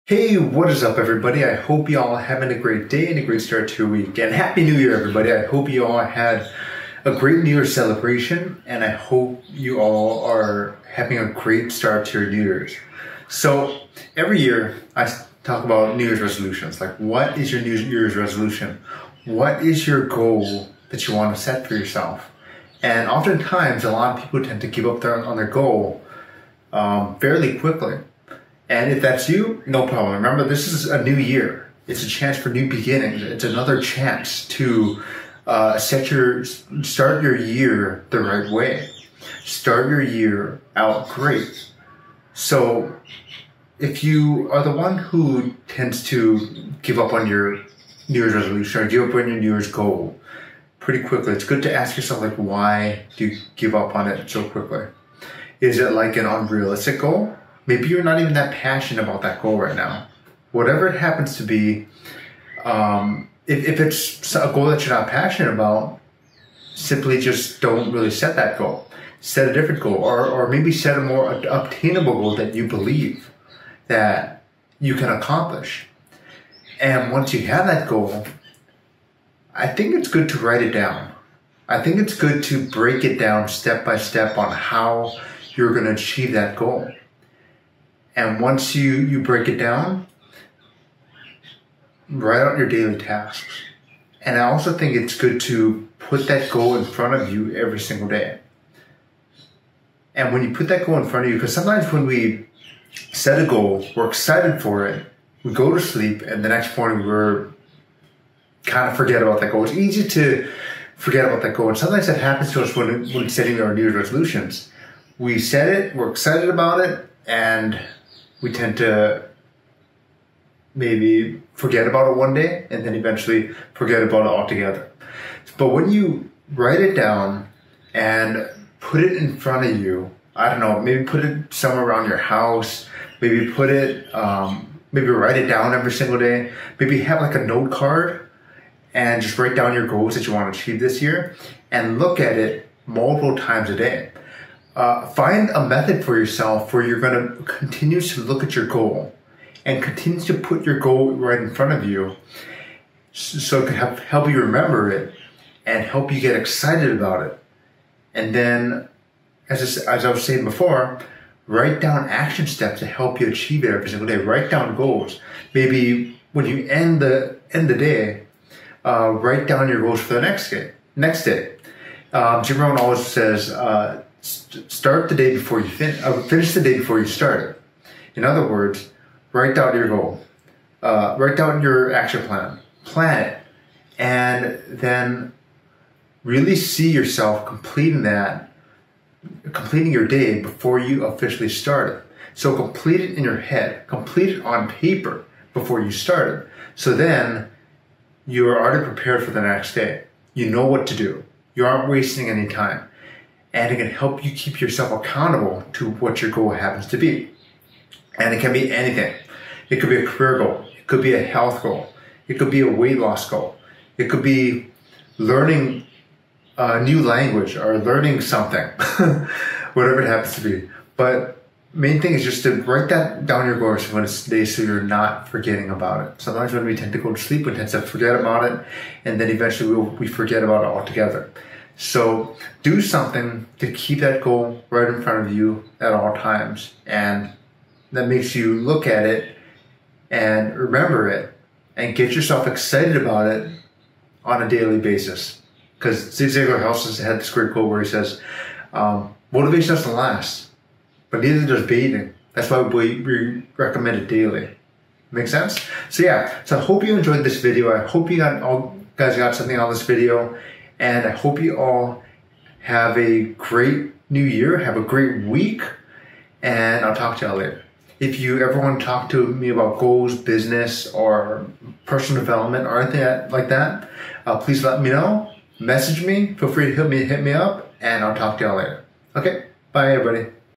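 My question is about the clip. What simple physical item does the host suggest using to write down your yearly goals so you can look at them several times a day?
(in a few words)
A note card.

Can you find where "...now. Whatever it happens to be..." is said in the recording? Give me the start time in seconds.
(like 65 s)
59 s.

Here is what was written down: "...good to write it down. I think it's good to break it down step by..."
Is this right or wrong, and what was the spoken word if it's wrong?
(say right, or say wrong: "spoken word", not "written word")
right.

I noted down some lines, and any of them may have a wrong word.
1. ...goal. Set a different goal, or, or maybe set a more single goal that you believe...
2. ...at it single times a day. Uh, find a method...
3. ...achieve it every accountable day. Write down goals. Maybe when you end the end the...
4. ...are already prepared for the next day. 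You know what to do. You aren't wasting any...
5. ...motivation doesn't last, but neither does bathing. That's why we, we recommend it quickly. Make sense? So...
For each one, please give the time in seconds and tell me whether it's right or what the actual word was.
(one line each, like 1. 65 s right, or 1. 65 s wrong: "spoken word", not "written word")
1. 68 s wrong: "obtainable", not "single"
2. 142 s wrong: "multiple", not "single"
3. 163 s wrong: "single", not "accountable"
4. 198 s right
5. 249 s wrong: "daily", not "quickly".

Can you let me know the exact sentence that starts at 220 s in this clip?
But main thing is just to write that down your goals for it's day so you're not forgetting about it.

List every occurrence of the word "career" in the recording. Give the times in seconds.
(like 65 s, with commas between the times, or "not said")
210 s.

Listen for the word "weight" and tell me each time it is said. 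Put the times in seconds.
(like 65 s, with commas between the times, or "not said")
212 s.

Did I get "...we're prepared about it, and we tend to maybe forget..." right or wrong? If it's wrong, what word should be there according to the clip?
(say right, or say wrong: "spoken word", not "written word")
wrong: "excited", not "prepared".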